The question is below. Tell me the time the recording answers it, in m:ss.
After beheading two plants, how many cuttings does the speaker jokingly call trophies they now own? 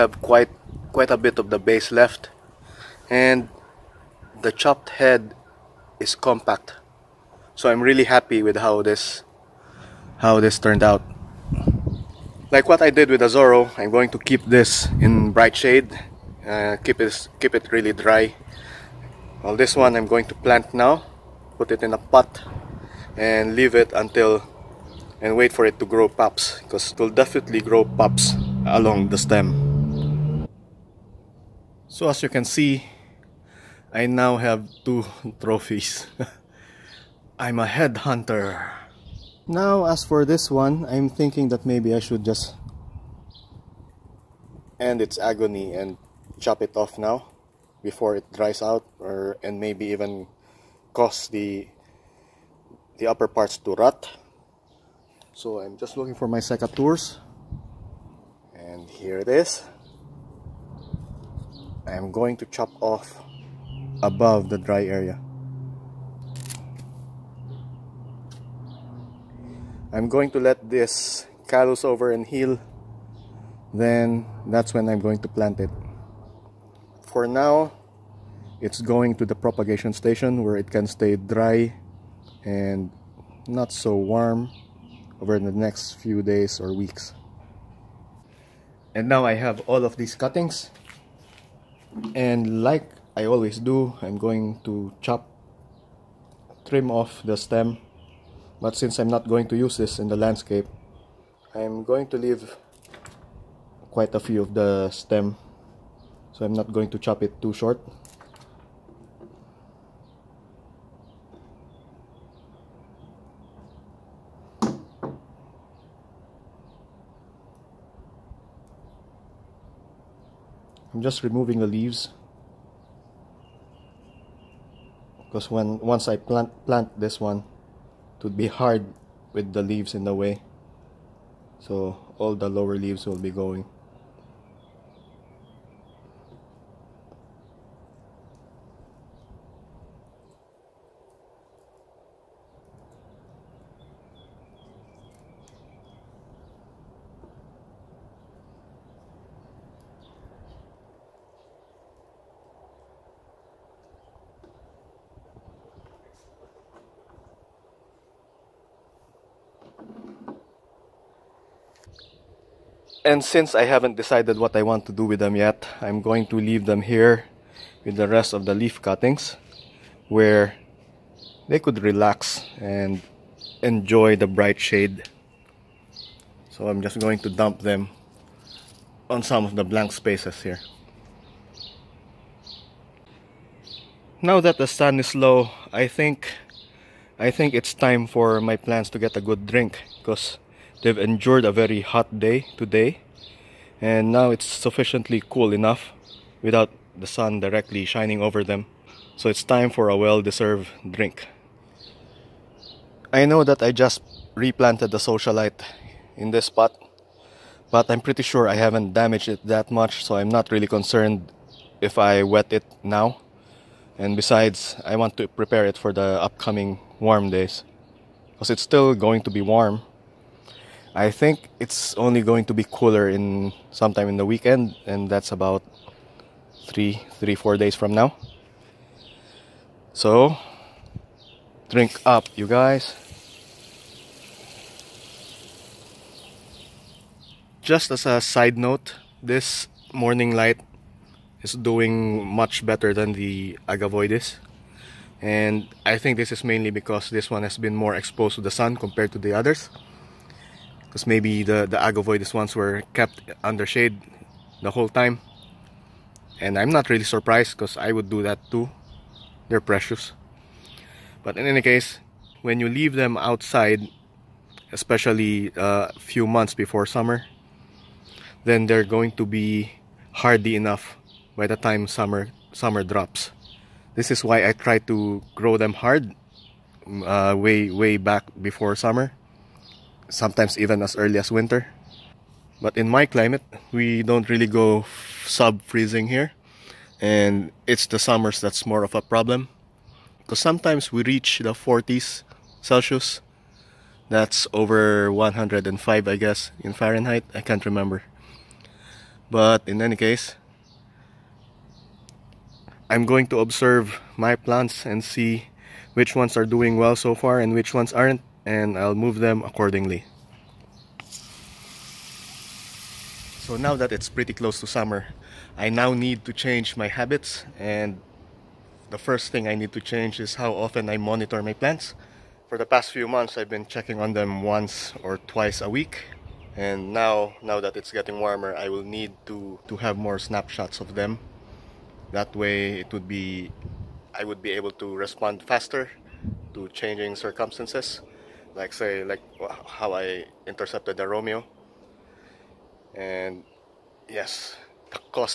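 0:34.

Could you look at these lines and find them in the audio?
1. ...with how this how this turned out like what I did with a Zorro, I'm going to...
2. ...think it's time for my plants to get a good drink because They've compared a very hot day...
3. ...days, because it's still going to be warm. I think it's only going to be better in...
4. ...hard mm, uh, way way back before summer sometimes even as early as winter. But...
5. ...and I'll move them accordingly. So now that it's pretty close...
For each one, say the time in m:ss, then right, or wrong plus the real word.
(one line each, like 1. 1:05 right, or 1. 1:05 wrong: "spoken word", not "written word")
1. 0:08 right
2. 3:07 wrong: "endured", not "compared"
3. 3:37 wrong: "cooler", not "better"
4. 4:35 right
5. 5:08 right.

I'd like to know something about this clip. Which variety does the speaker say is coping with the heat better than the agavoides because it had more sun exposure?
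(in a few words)
Morning Light.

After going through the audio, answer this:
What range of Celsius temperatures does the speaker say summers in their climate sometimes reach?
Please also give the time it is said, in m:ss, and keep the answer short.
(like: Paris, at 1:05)
40s, at 4:51.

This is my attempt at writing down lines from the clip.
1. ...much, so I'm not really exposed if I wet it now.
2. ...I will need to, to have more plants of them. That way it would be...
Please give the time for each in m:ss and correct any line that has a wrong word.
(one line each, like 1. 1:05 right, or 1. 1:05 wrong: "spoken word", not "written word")
1. 3:29 wrong: "concerned", not "exposed"
2. 5:28 wrong: "snapshots", not "plants".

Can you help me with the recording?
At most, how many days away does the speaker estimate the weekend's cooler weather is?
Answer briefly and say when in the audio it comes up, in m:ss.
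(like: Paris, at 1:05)
4, at 3:47.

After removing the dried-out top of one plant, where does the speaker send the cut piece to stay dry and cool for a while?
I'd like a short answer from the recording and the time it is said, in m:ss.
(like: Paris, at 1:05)
propagation station, at 1:19.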